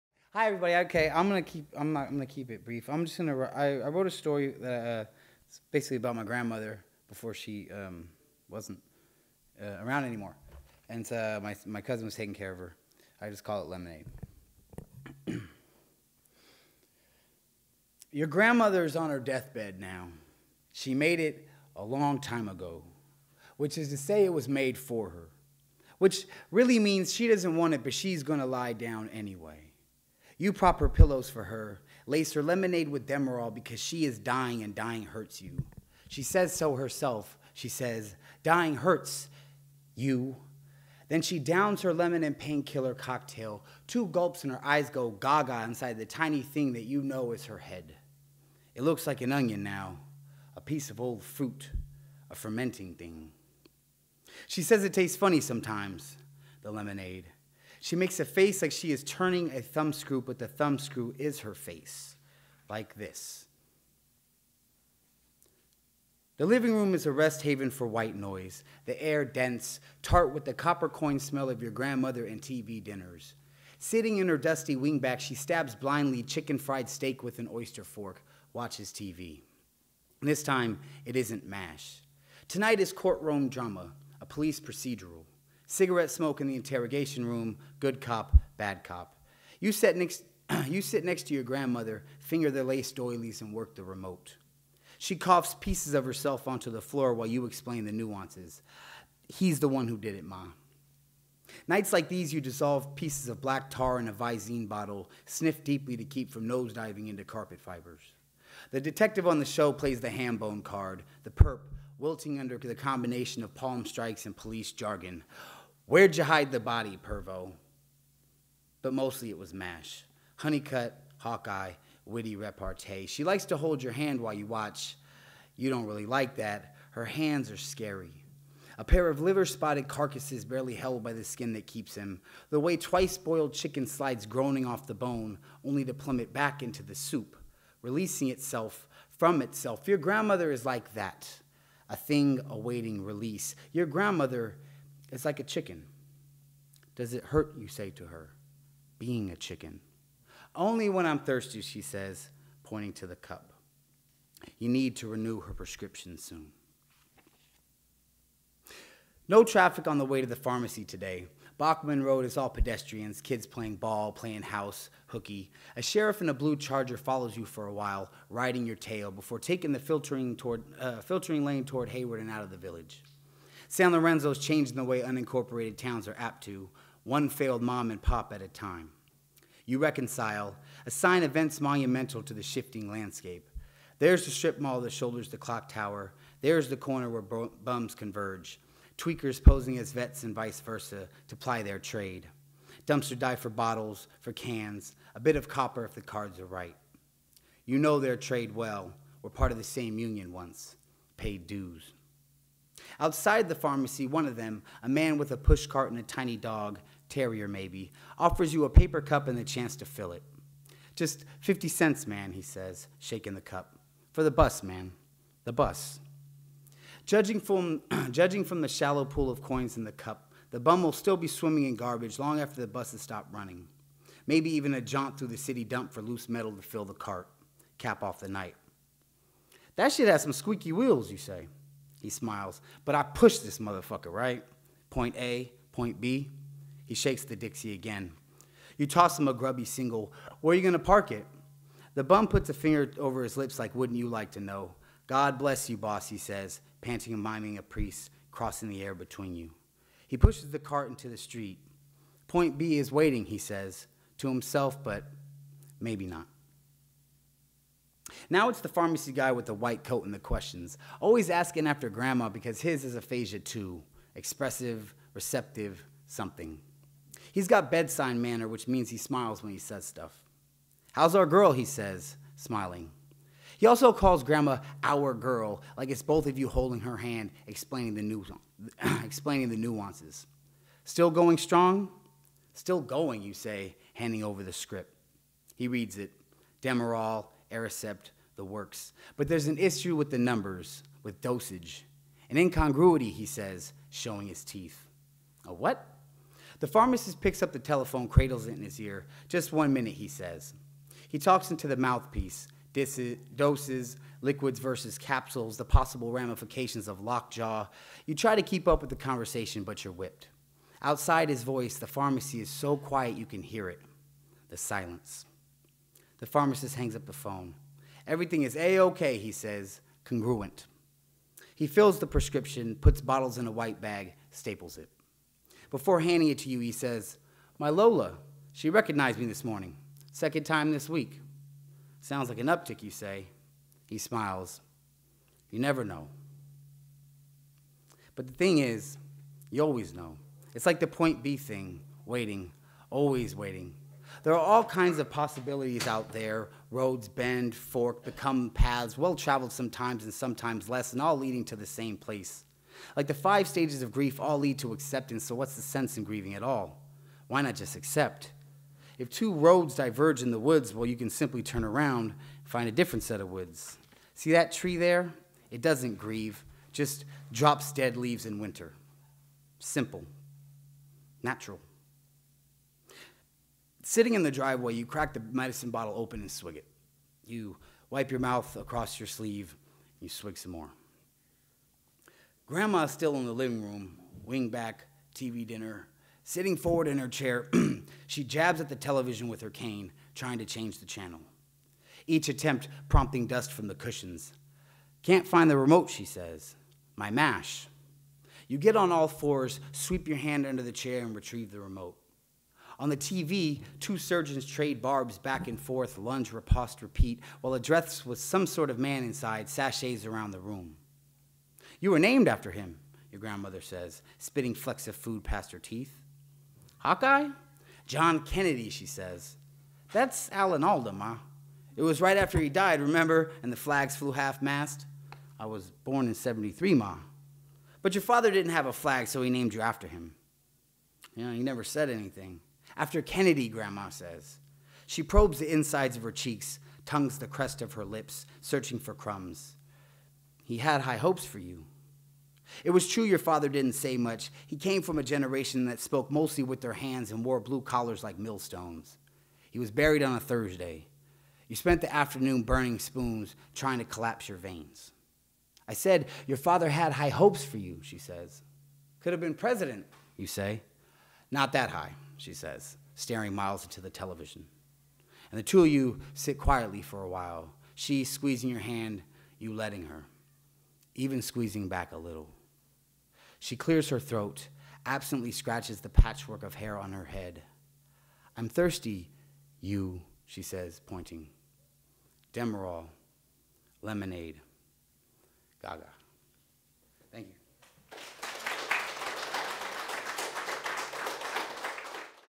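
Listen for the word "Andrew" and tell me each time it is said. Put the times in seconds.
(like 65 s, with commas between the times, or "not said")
not said.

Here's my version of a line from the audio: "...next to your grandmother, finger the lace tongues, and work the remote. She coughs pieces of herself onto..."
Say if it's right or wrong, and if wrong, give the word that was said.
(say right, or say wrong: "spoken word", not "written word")
wrong: "doilies", not "tongues".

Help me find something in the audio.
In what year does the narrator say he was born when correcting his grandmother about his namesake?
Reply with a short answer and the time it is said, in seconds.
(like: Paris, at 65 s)
1973, at 426 s.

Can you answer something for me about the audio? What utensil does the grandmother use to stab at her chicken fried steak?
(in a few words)
Oyster fork.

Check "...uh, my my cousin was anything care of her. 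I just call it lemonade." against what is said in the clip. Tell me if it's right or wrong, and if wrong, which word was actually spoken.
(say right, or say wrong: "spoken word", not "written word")
wrong: "taking", not "anything".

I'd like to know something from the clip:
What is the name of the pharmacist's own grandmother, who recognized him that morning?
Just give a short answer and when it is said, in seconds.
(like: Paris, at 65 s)
Lola, at 327 s.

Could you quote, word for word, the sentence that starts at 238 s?
You toss him a grubby single.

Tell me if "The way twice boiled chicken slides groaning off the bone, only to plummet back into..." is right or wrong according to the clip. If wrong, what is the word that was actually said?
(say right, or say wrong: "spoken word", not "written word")
right.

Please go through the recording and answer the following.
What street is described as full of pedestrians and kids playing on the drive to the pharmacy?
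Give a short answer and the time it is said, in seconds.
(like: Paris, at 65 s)
Bachman Road, at 161 s.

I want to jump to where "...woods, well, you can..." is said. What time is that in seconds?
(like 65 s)
360 s.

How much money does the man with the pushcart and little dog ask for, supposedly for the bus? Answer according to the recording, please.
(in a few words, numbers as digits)
50 cents.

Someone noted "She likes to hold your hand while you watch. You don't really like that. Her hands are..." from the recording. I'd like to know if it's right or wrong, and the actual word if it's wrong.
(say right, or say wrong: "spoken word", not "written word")
right.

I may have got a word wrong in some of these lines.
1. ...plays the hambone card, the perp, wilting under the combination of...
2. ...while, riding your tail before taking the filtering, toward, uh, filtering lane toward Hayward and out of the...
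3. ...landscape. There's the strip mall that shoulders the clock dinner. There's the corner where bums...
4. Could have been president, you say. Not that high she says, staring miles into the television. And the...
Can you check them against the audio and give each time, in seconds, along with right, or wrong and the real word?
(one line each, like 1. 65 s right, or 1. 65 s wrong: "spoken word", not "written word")
1. 109 s right
2. 167 s right
3. 182 s wrong: "tower", not "dinner"
4. 458 s right.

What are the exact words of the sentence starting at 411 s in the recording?
You were named after him, your grandmother says, spitting flecks of food past her teeth.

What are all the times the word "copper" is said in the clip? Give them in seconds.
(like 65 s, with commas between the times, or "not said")
70 s, 195 s.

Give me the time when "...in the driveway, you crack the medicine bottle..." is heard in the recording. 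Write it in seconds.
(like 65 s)
374 s.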